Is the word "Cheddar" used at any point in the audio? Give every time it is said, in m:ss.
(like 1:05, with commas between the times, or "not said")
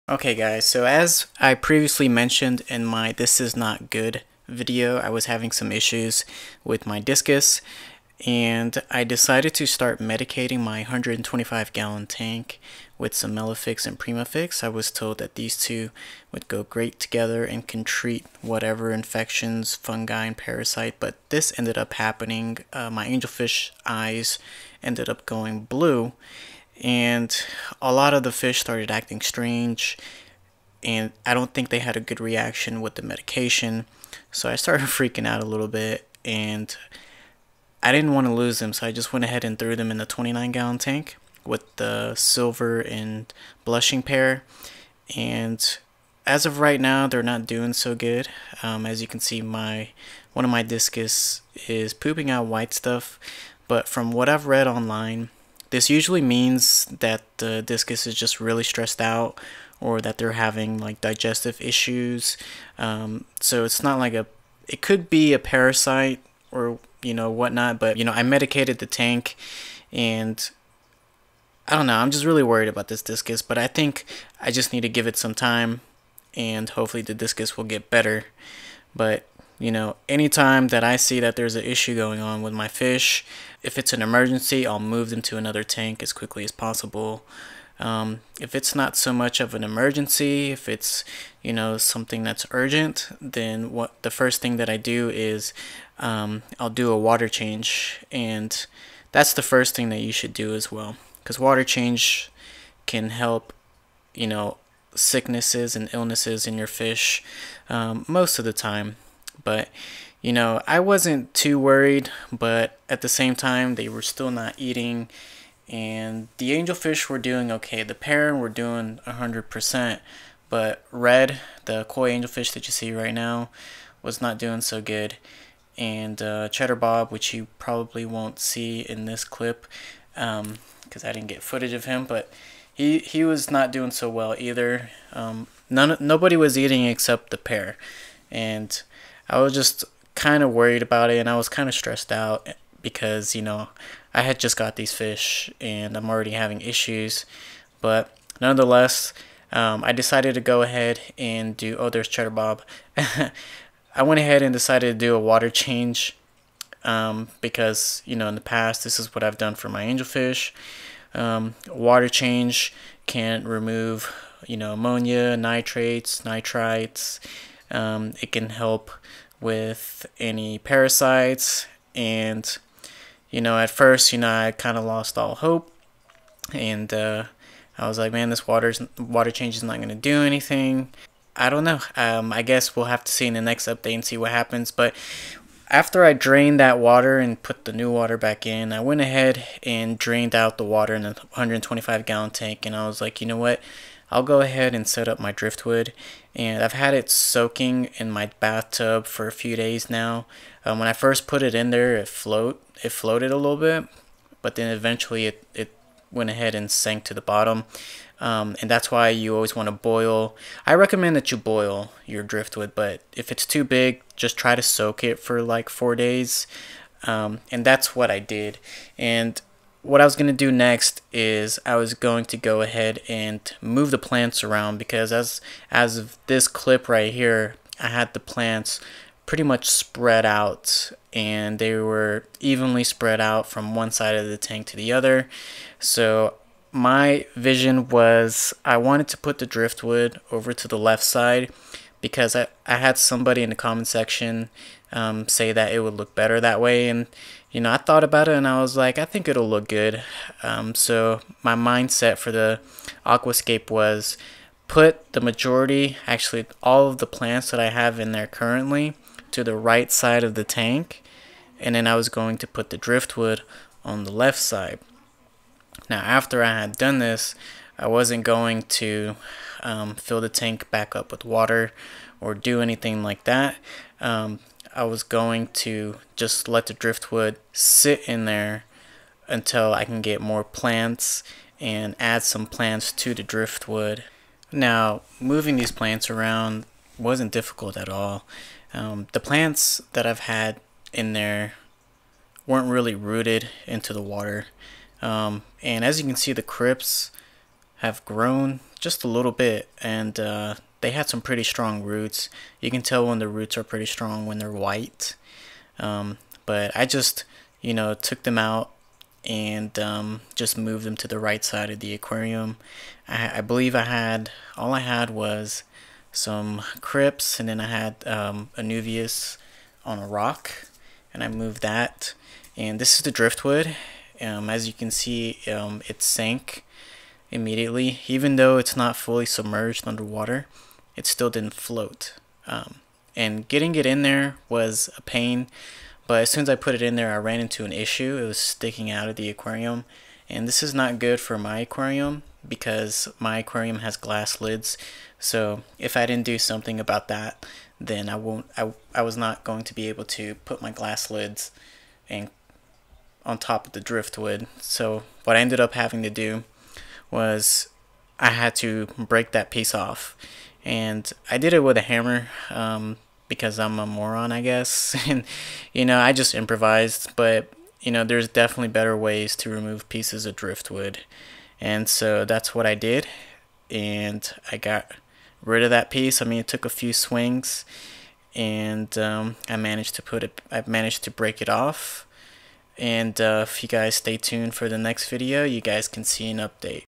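2:06, 2:32.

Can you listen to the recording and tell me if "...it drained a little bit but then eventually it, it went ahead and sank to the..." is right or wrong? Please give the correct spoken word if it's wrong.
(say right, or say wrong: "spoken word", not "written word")
wrong: "floated", not "drained".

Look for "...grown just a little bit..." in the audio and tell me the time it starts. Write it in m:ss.
4:58.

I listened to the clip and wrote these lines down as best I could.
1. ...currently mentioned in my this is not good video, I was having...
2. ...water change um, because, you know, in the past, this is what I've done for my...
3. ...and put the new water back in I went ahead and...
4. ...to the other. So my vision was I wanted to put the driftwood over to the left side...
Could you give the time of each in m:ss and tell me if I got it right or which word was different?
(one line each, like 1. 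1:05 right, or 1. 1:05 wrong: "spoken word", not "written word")
1. 0:01 wrong: "previously", not "currently"
2. 2:35 right
3. 3:07 right
4. 3:54 right.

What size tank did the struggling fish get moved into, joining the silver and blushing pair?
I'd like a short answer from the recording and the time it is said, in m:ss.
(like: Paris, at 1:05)
29 gallon, at 0:40.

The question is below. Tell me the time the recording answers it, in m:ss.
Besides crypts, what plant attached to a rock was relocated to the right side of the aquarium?
5:18.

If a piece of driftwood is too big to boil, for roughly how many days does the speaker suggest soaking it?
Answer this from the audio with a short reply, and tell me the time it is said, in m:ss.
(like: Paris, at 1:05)
4 days, at 3:35.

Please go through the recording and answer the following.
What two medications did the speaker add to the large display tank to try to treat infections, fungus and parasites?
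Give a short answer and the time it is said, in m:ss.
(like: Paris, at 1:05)
Melafix and Primafix, at 0:13.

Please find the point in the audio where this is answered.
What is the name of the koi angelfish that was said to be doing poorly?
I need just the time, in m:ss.
2:00.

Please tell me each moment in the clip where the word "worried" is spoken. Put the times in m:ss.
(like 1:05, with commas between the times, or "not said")
1:12, 1:51, 2:20.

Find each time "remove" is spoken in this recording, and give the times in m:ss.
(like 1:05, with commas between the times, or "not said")
2:43, 6:09.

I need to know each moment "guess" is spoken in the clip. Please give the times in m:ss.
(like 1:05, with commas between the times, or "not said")
3:02, 6:04.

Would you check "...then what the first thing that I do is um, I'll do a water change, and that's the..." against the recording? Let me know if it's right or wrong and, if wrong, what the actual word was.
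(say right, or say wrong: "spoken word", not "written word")
right.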